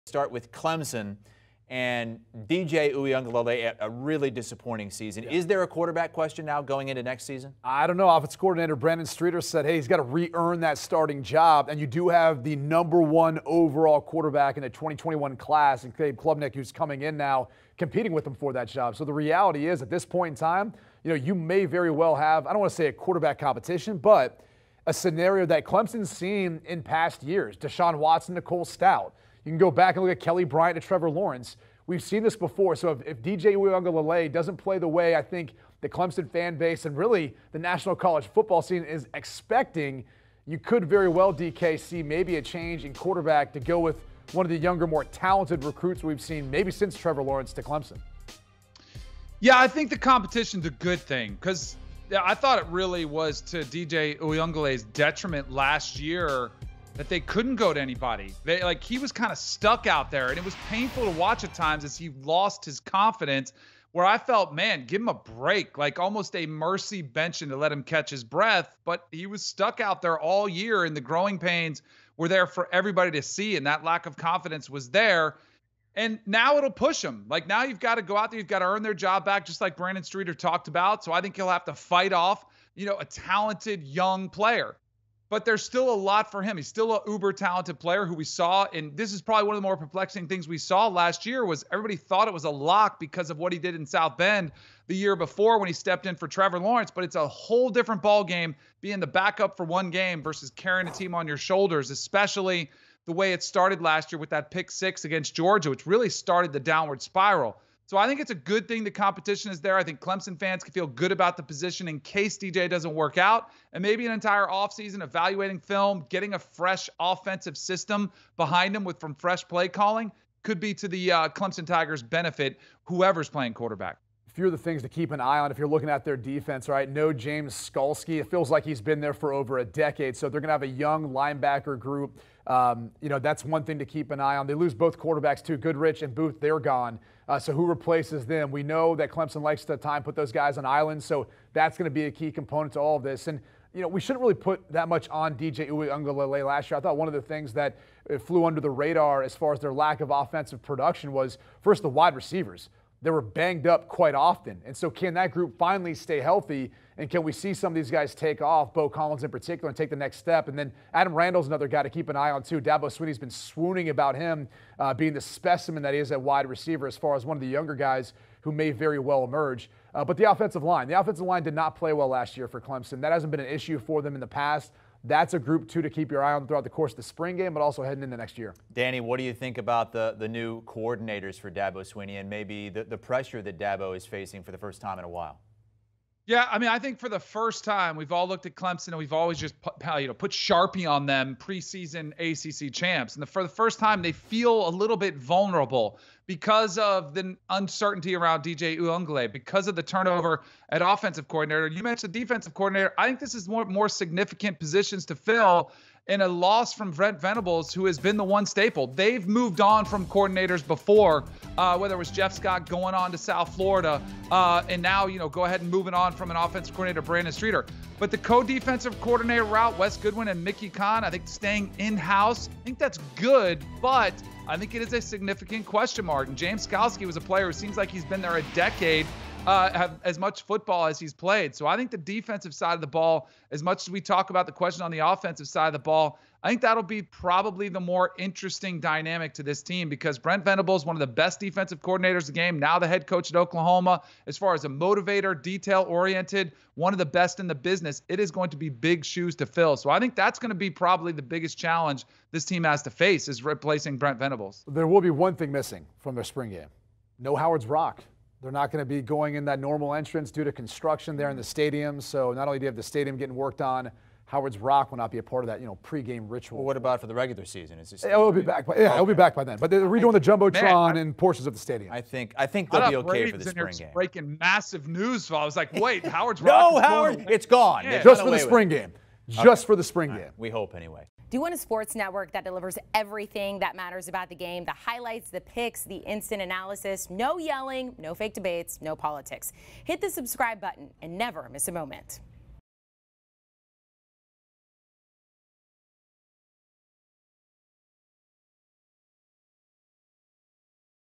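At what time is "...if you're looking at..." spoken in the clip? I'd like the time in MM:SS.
02:05.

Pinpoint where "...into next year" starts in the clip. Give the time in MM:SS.
02:58.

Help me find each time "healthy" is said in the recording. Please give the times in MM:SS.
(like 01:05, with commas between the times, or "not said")
02:36.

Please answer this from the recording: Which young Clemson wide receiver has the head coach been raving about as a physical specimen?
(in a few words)
Adam Randall.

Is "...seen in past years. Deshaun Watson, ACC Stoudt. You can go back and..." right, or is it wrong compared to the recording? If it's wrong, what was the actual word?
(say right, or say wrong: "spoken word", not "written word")
wrong: "Nicole", not "ACC".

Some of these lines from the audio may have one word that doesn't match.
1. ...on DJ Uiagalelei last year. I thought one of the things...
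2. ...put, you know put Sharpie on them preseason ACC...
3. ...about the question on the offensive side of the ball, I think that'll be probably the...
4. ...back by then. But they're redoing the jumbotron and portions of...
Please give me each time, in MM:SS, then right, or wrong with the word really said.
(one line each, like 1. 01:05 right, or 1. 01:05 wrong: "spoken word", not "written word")
1. 02:25 right
2. 03:09 right
3. 03:54 right
4. 04:29 right.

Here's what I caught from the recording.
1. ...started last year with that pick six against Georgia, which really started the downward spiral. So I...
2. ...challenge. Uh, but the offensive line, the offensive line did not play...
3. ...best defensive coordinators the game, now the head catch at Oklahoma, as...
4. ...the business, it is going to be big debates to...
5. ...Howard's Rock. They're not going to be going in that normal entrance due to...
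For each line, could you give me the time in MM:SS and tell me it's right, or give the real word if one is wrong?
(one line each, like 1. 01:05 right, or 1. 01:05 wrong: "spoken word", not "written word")
1. 01:43 right
2. 02:49 wrong: "emerge", not "challenge"
3. 04:01 wrong: "coach", not "catch"
4. 04:07 wrong: "shoes", not "debates"
5. 04:17 right.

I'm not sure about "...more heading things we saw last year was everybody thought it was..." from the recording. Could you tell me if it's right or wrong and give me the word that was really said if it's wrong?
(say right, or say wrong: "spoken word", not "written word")
wrong: "perplexing", not "heading".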